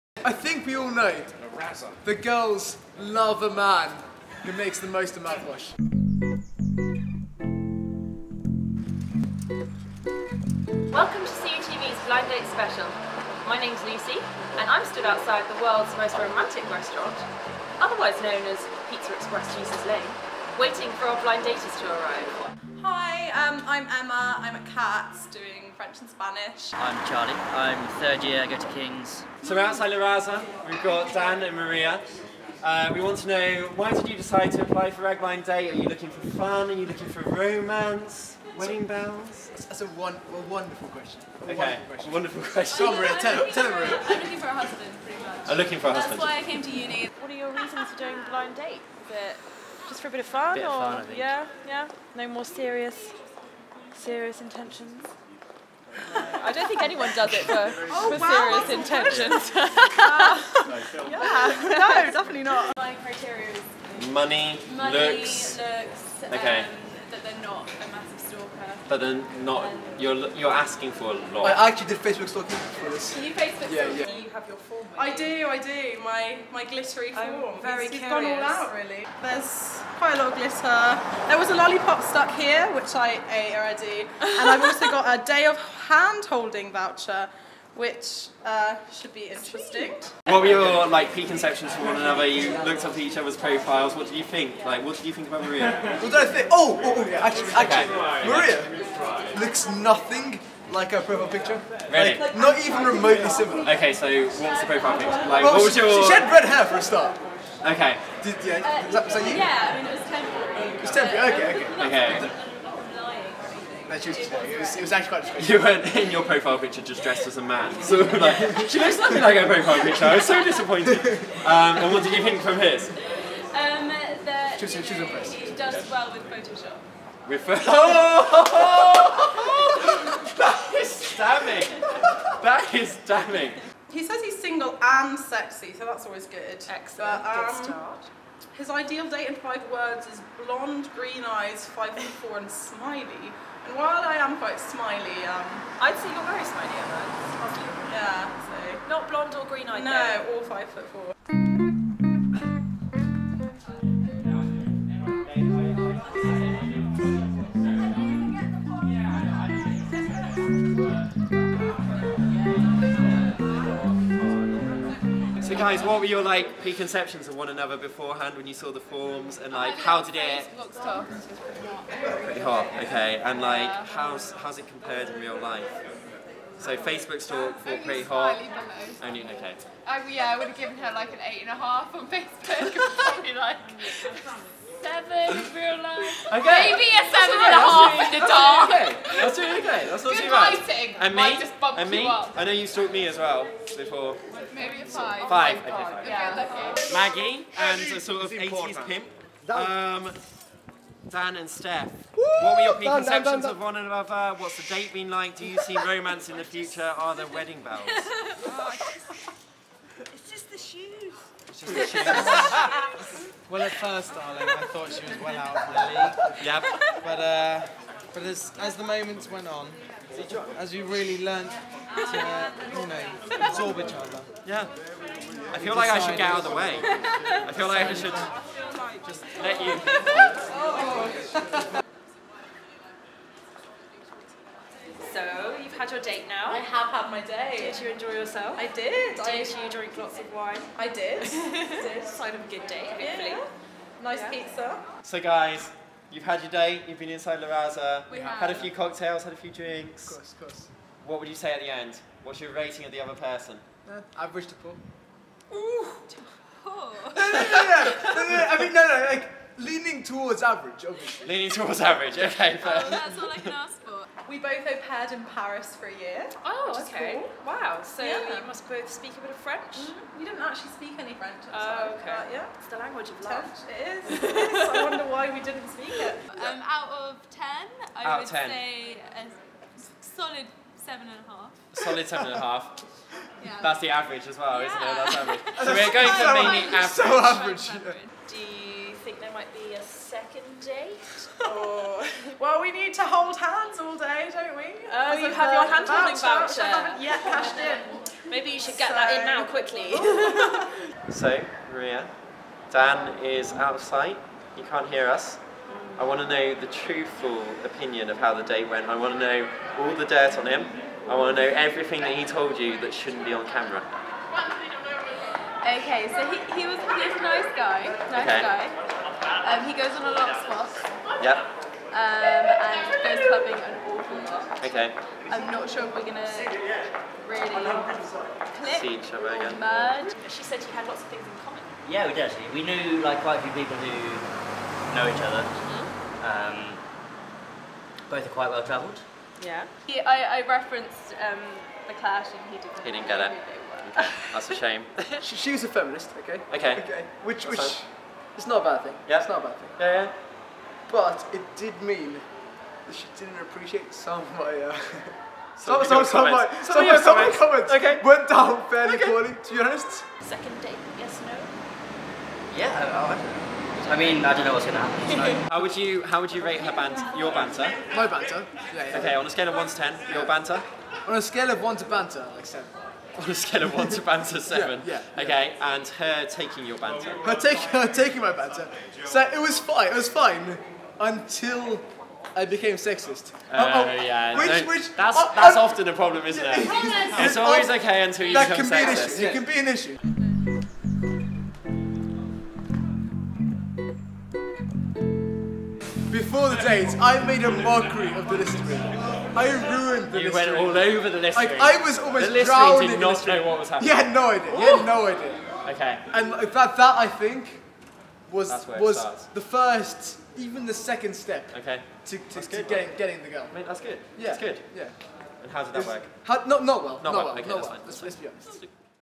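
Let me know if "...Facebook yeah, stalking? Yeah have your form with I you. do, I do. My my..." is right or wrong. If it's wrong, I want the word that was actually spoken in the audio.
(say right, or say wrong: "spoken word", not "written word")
right.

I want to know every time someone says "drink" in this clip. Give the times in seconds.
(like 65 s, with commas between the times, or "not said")
239 s, 249 s.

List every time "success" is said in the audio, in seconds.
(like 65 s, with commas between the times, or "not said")
not said.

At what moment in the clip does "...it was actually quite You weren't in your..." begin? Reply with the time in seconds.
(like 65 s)
114 s.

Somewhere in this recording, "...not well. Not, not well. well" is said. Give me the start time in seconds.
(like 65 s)
416 s.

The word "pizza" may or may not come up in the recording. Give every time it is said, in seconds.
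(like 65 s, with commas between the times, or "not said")
18 s, 244 s.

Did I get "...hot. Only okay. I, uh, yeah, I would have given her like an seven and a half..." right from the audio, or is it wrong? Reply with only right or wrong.
wrong.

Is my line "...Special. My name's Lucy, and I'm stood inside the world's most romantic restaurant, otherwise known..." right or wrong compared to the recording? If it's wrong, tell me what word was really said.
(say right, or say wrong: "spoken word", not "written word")
wrong: "outside", not "inside".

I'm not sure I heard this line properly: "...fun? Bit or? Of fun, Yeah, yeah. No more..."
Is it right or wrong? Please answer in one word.
right.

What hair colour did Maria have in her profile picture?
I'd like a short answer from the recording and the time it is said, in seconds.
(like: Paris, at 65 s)
Red, at 106 s.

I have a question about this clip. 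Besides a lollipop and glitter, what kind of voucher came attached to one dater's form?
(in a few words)
hand-holding voucher.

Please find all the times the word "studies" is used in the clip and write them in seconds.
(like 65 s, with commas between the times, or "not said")
not said.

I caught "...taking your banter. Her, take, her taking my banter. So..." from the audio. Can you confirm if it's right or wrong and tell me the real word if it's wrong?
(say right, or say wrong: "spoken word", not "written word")
right.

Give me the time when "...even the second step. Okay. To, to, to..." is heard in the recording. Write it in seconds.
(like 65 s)
410 s.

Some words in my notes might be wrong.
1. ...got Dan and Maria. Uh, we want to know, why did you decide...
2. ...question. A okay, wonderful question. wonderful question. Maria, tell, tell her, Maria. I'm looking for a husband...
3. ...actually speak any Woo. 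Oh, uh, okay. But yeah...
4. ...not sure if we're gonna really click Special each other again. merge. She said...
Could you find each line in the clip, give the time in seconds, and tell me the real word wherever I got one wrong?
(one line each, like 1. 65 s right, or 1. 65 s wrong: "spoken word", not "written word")
1. 30 s right
2. 40 s right
3. 270 s wrong: "French", not "Woo"
4. 325 s wrong: "See", not "Special".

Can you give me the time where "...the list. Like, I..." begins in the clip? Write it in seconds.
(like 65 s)
401 s.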